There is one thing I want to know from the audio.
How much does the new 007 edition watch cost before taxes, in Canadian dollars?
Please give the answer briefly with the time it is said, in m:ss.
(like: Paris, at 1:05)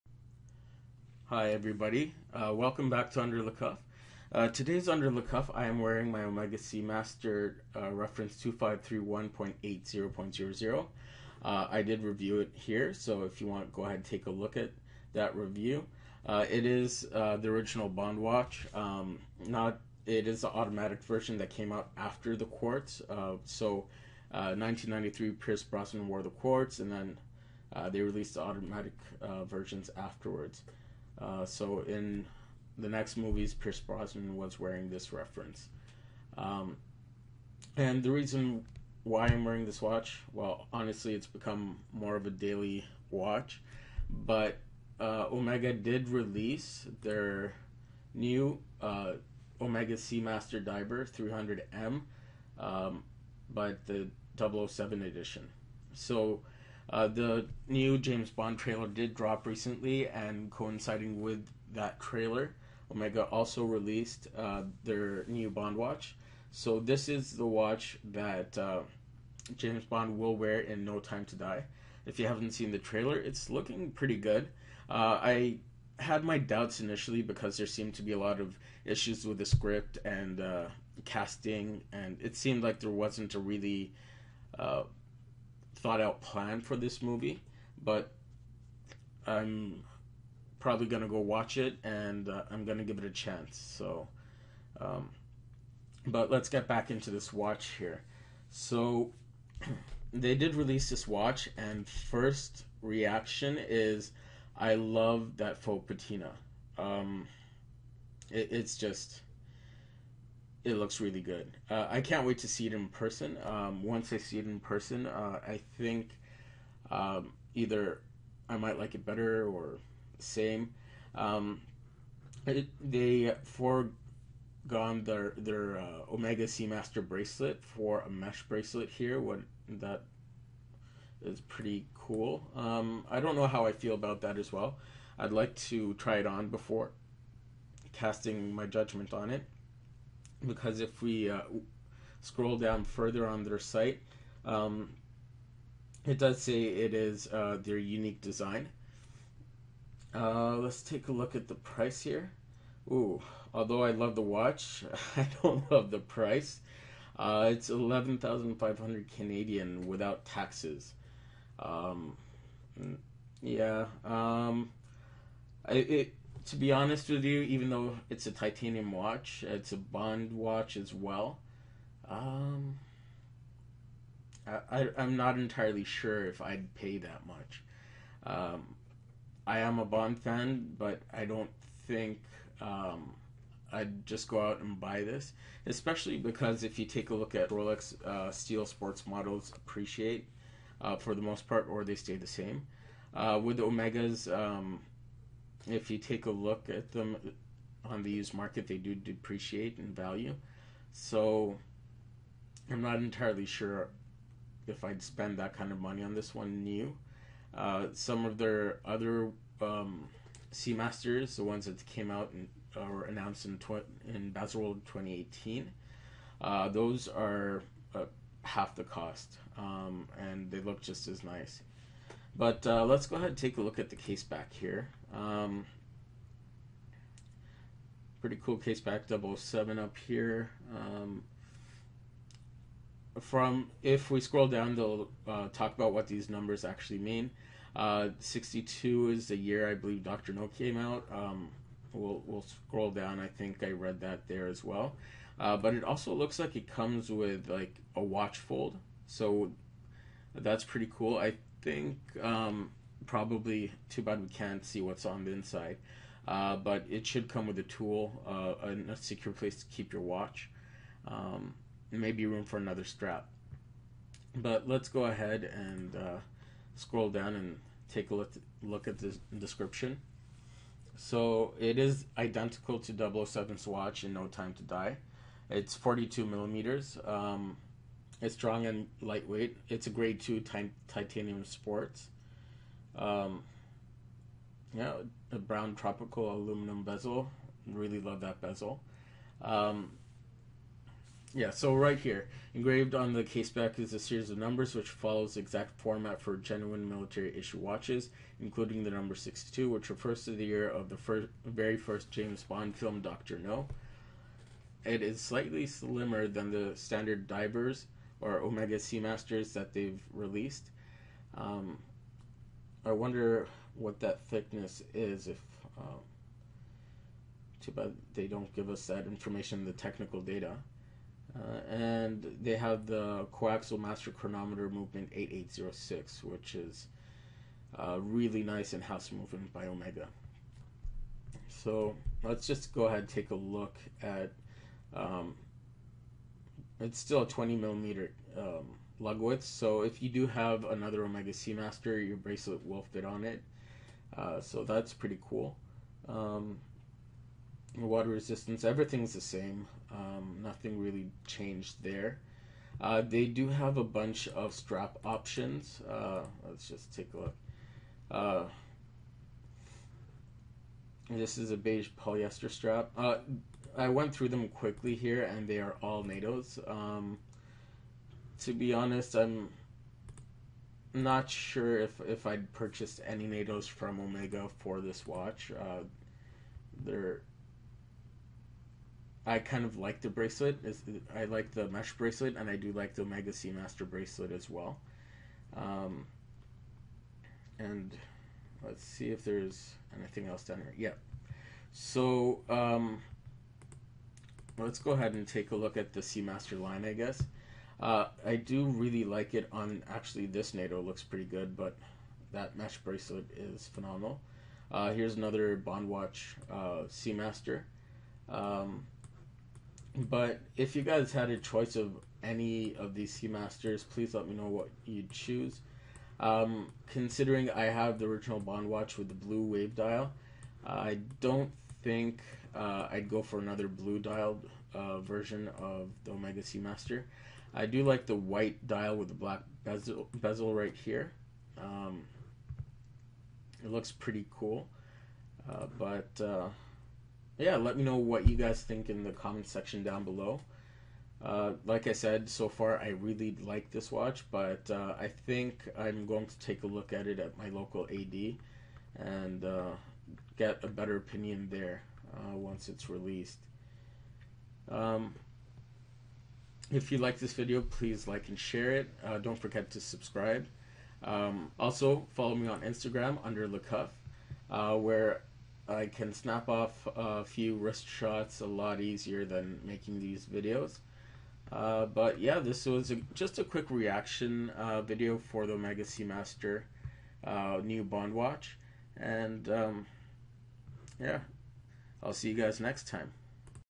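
11,500, at 2:37.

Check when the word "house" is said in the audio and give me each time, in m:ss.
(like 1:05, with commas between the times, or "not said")
5:28.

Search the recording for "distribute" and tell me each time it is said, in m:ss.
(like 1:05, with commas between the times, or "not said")
not said.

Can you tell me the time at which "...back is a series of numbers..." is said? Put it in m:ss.
4:53.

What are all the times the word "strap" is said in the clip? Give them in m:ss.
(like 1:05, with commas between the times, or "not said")
4:22, 5:54, 6:02.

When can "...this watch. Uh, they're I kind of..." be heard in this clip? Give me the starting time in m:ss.
6:14.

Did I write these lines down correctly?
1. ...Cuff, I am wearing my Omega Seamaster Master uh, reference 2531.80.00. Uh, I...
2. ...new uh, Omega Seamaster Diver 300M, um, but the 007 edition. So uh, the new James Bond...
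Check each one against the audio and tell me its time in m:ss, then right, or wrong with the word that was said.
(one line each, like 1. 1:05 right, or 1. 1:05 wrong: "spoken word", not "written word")
1. 0:05 right
2. 0:48 right.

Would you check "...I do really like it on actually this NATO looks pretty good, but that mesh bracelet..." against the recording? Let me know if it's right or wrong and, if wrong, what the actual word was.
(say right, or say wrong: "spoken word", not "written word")
right.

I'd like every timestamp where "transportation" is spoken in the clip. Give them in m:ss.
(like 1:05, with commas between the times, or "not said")
not said.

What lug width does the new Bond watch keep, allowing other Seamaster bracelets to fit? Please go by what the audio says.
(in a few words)
20 millimeters.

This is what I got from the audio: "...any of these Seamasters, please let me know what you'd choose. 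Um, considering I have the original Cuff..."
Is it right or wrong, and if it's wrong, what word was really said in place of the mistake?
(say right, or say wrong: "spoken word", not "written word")
wrong: "Bondwatch", not "Cuff".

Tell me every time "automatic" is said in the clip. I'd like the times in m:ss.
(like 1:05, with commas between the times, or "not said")
0:20, 0:28.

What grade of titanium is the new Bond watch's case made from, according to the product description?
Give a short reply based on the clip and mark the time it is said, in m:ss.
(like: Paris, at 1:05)
Grade two, at 4:39.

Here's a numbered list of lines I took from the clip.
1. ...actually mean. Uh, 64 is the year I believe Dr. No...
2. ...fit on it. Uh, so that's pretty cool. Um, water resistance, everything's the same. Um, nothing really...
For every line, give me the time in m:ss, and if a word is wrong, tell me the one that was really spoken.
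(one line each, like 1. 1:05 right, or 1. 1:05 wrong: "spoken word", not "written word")
1. 3:56 wrong: "62", not "64"
2. 5:42 right.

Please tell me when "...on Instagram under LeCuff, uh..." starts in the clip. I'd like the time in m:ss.
7:42.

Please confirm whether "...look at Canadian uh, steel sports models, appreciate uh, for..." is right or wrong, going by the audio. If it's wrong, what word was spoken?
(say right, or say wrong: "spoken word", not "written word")
wrong: "Rolex", not "Canadian".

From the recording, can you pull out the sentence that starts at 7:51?
Uh, but yeah, this was a, just a quick reaction uh, video for the Omega Seamaster uh, new Bond watch.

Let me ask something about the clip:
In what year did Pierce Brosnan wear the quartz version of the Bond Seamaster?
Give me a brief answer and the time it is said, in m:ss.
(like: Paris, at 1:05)
1993, at 0:24.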